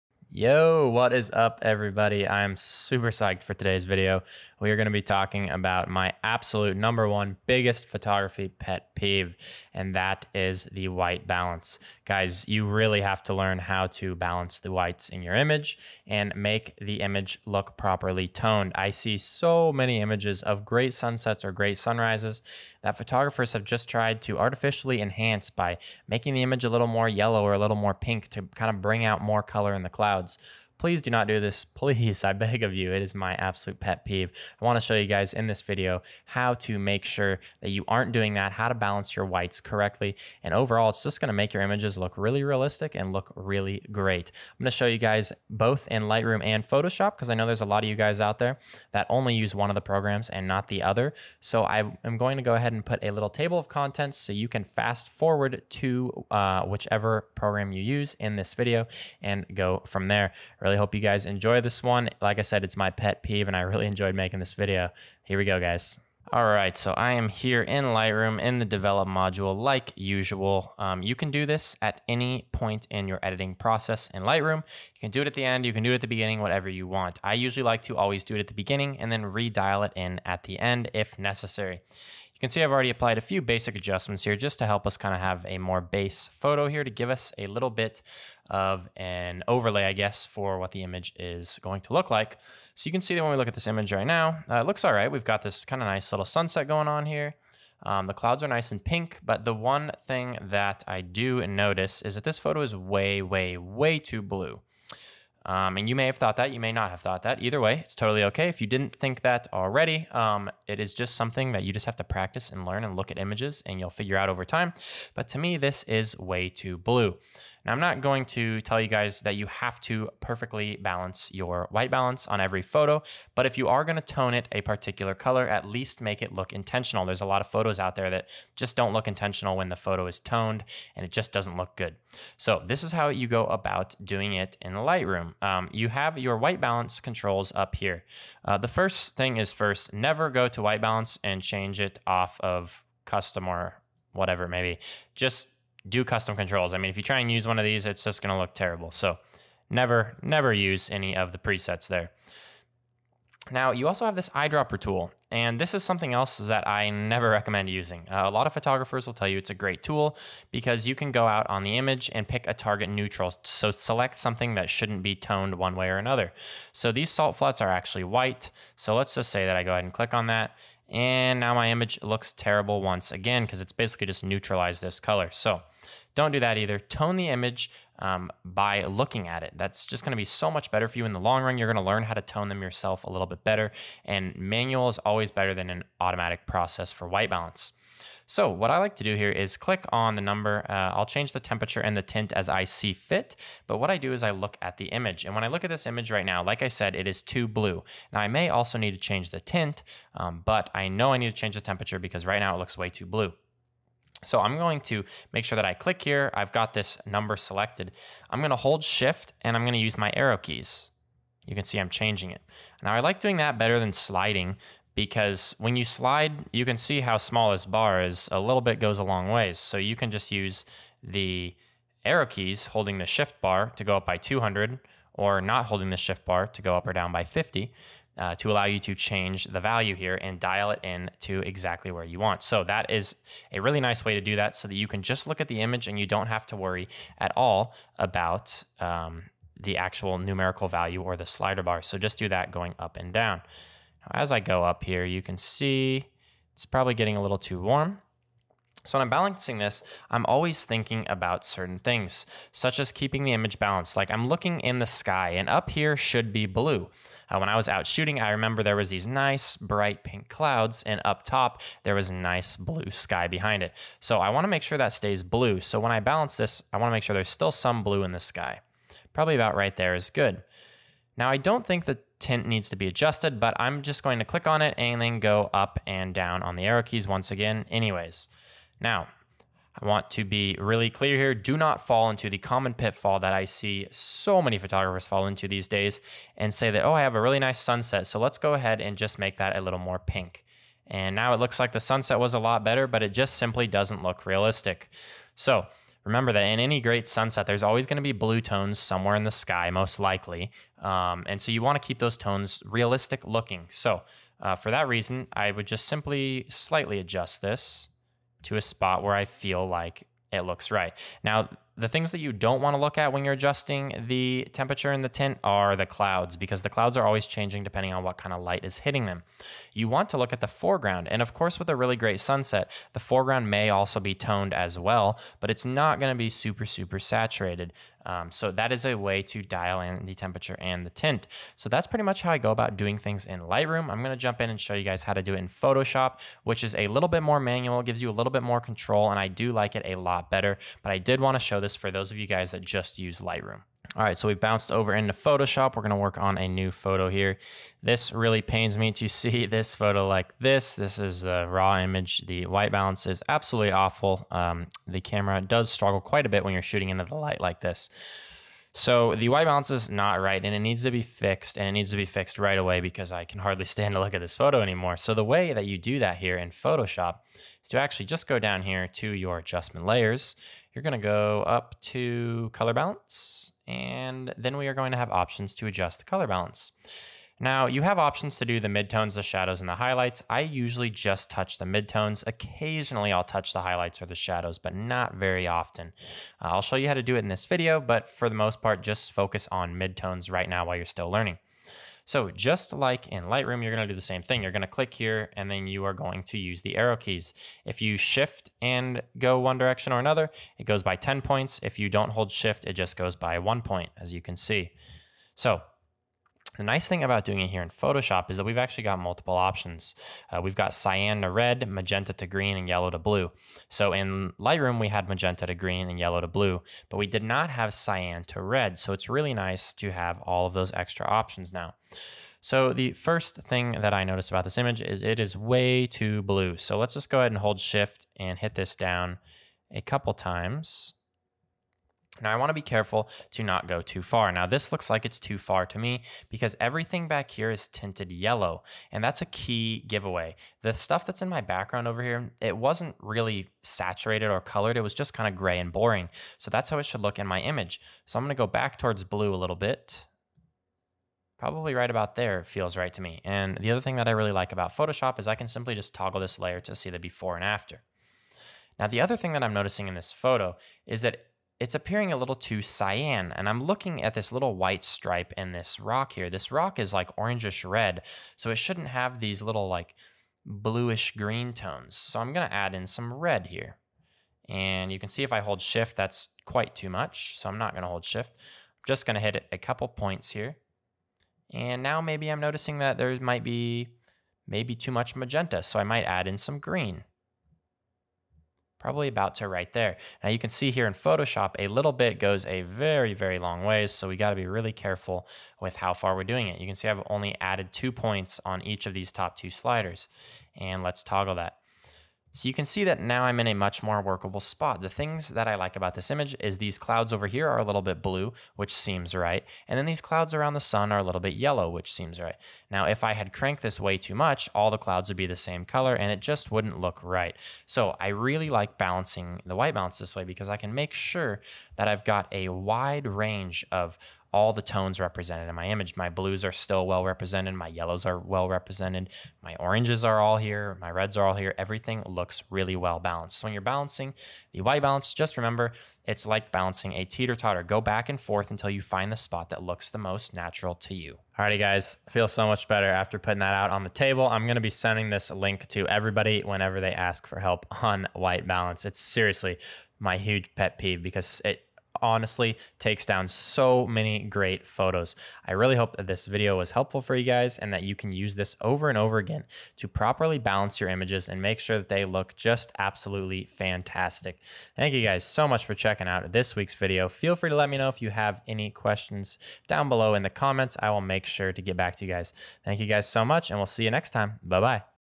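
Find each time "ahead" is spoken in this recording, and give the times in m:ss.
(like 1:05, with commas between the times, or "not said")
0:52, 2:49, 4:48, 7:07.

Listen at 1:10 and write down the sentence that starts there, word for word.
Um, you can do this at any point in your editing process in Lightroom.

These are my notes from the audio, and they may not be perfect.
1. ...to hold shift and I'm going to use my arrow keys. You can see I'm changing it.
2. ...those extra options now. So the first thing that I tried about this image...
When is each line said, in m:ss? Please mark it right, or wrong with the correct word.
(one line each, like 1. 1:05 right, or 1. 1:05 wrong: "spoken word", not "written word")
1. 3:28 right
2. 7:00 wrong: "noticed", not "tried".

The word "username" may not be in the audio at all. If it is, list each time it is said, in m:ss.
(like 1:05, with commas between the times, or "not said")
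not said.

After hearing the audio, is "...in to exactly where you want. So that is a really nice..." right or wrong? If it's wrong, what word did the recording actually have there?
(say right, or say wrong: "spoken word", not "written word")
right.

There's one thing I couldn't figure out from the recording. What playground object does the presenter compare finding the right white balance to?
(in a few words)
teeter totter.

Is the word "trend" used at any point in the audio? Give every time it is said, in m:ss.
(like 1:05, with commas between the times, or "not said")
not said.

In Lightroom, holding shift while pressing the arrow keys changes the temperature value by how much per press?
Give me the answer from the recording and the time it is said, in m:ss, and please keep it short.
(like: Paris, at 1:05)
200, at 3:44.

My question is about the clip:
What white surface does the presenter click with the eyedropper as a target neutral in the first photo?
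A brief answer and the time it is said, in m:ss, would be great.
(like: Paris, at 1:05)
salt flats, at 2:47.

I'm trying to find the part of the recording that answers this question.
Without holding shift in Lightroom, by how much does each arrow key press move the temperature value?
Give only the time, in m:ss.
3:47.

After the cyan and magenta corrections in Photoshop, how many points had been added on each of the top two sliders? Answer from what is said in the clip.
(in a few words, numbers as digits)
2.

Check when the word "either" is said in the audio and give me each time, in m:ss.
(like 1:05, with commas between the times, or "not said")
1:47, 2:56.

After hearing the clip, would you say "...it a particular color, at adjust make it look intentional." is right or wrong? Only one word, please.
wrong.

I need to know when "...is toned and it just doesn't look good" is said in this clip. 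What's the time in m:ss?
2:10.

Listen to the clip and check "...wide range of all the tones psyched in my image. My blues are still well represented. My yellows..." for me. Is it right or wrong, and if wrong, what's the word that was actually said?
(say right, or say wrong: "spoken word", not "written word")
wrong: "represented", not "psyched".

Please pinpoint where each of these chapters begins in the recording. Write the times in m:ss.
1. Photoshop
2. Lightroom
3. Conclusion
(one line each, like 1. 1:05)
1. 5:43
2. 1:05
3. 9:00.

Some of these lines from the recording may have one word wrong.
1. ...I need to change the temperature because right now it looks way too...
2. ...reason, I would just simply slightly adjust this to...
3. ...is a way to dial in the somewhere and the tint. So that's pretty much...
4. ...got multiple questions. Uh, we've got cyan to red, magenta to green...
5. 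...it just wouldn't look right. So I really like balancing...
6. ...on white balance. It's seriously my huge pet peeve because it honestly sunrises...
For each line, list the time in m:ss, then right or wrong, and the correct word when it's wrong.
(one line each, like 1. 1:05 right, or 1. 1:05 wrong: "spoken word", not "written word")
1. 3:21 right
2. 5:04 right
3. 5:28 wrong: "temperature", not "somewhere"
4. 6:48 wrong: "options", not "questions"
5. 8:36 right
6. 9:07 wrong: "takes", not "sunrises".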